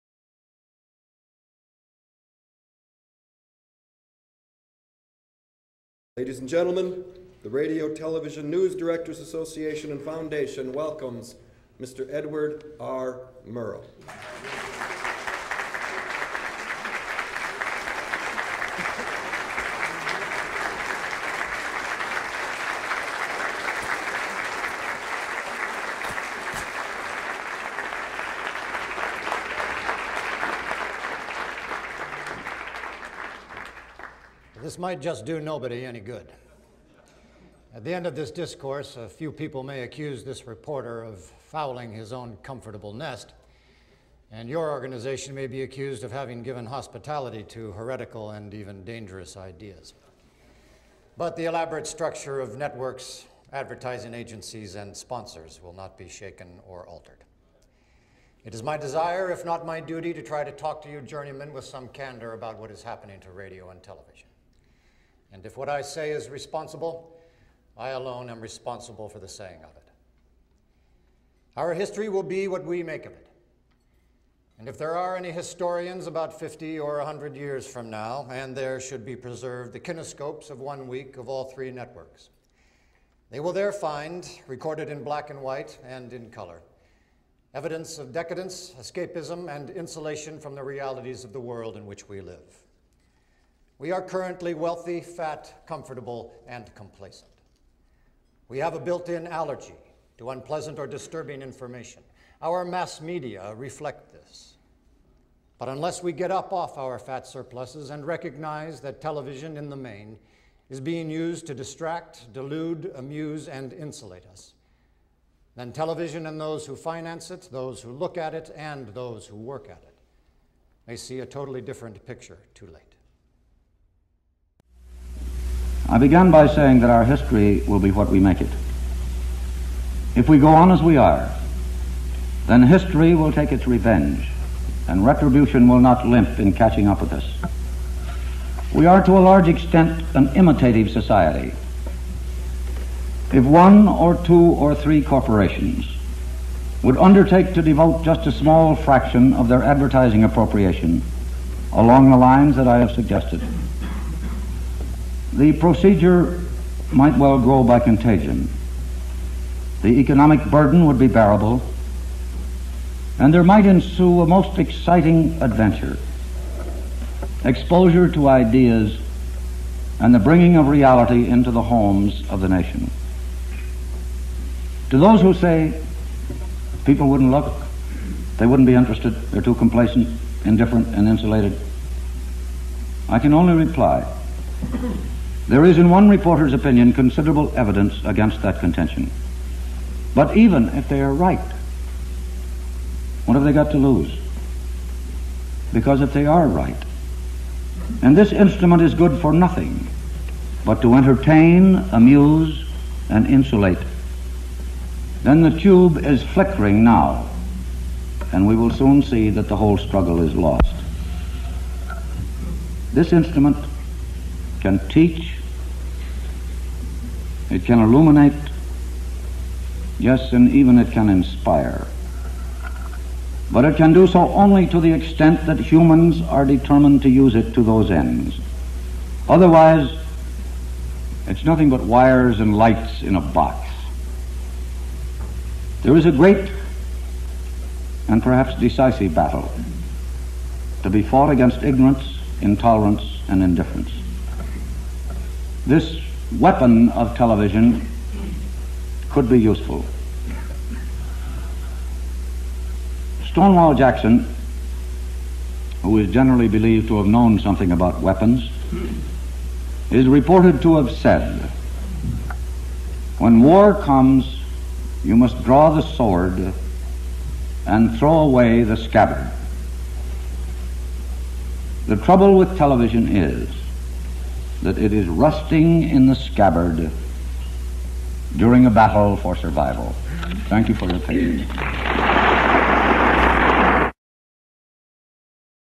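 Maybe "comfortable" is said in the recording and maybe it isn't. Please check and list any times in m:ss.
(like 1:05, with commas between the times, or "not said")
0:42, 1:35.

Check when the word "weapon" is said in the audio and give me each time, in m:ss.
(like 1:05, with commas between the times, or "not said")
4:06, 4:18.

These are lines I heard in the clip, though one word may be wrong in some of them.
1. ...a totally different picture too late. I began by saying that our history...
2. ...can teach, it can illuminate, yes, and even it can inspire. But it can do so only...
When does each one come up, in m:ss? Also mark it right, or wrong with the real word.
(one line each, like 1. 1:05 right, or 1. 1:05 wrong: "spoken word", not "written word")
1. 2:01 right
2. 3:34 right.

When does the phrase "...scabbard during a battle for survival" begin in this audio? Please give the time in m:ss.
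4:36.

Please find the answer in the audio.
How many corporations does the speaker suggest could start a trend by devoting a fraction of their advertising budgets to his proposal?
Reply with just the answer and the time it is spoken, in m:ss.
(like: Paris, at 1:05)
1, 2 or 3, at 2:23.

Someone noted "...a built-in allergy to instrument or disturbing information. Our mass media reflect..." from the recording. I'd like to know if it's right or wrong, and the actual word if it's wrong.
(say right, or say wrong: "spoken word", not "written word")
wrong: "unpleasant", not "instrument".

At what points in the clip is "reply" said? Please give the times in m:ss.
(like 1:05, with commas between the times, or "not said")
3:03.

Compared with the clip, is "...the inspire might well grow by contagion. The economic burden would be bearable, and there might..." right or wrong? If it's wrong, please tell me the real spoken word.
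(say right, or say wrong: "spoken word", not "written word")
wrong: "procedure", not "inspire".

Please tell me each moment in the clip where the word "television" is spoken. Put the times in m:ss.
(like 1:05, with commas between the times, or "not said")
0:07, 1:03, 1:49, 1:55, 4:07, 4:32.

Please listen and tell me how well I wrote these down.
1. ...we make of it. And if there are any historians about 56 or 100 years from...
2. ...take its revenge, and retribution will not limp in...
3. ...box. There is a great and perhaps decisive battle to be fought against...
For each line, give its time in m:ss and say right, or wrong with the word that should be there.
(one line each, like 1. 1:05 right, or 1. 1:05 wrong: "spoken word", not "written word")
1. 1:12 wrong: "50", not "56"
2. 2:13 right
3. 3:53 right.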